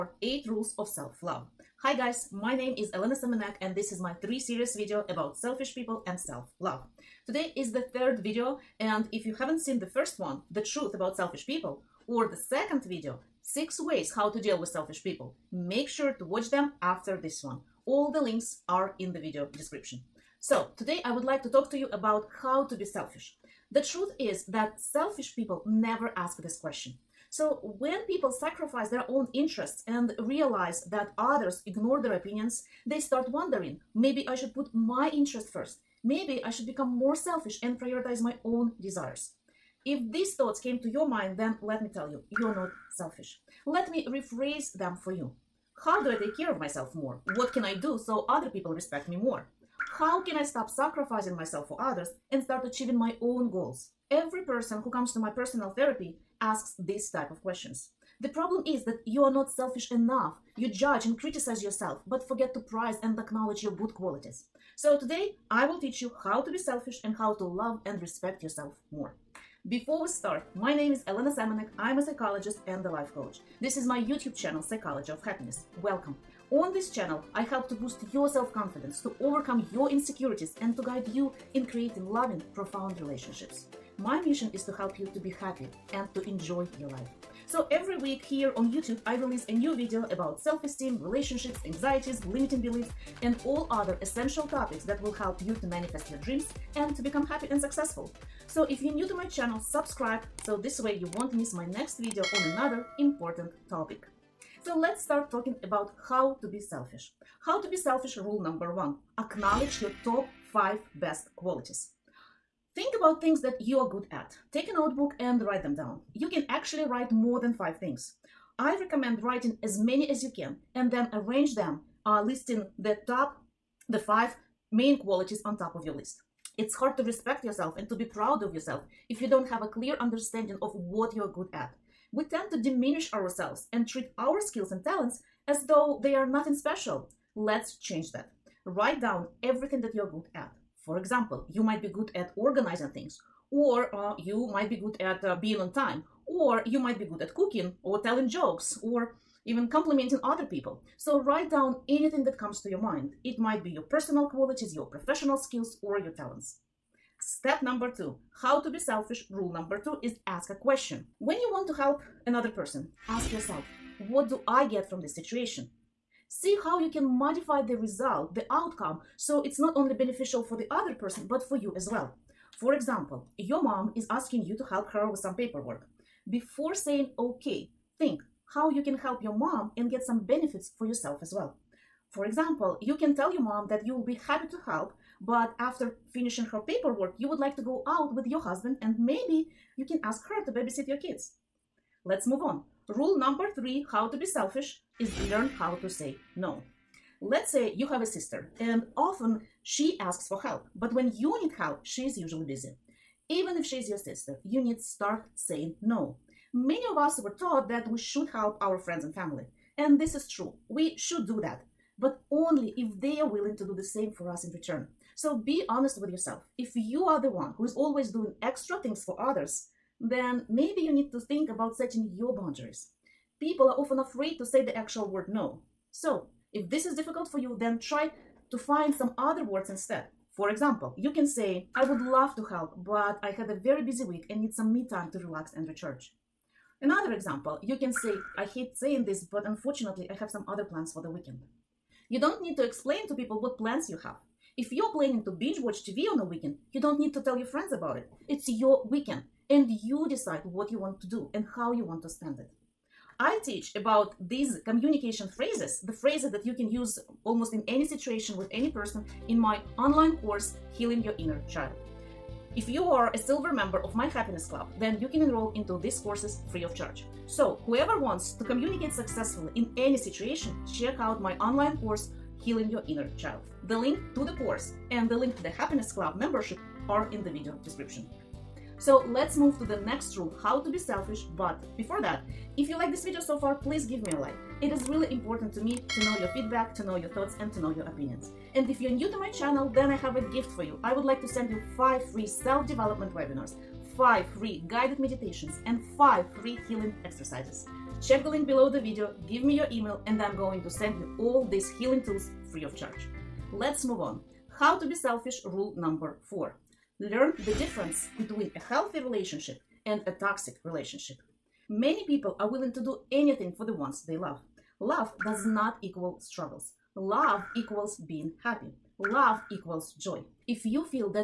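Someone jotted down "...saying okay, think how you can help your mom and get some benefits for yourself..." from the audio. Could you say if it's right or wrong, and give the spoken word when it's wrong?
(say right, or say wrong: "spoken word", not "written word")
right.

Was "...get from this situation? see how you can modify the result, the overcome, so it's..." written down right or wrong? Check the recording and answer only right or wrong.
wrong.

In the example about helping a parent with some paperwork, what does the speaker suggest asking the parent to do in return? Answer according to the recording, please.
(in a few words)
babysit your kids.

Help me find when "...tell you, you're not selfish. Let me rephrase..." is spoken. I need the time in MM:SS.
00:41.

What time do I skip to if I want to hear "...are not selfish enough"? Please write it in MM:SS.
00:59.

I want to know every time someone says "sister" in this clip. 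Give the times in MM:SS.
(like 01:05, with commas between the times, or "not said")
03:18, 03:23.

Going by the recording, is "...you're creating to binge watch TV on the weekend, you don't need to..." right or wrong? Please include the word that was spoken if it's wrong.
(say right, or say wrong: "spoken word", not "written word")
wrong: "planning", not "creating".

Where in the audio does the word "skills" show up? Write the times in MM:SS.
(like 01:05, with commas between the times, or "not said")
02:14, 02:35.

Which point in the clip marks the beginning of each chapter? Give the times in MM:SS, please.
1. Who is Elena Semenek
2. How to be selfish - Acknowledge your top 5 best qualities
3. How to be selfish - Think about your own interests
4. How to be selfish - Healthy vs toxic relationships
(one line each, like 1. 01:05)
1. 01:09
2. 01:44
3. 02:38
4. 05:04.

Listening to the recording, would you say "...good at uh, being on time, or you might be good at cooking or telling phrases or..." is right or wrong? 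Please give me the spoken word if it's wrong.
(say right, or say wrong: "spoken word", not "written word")
wrong: "jokes", not "phrases".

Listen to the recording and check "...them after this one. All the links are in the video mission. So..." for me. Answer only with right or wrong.
wrong.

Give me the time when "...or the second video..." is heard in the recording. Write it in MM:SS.
00:12.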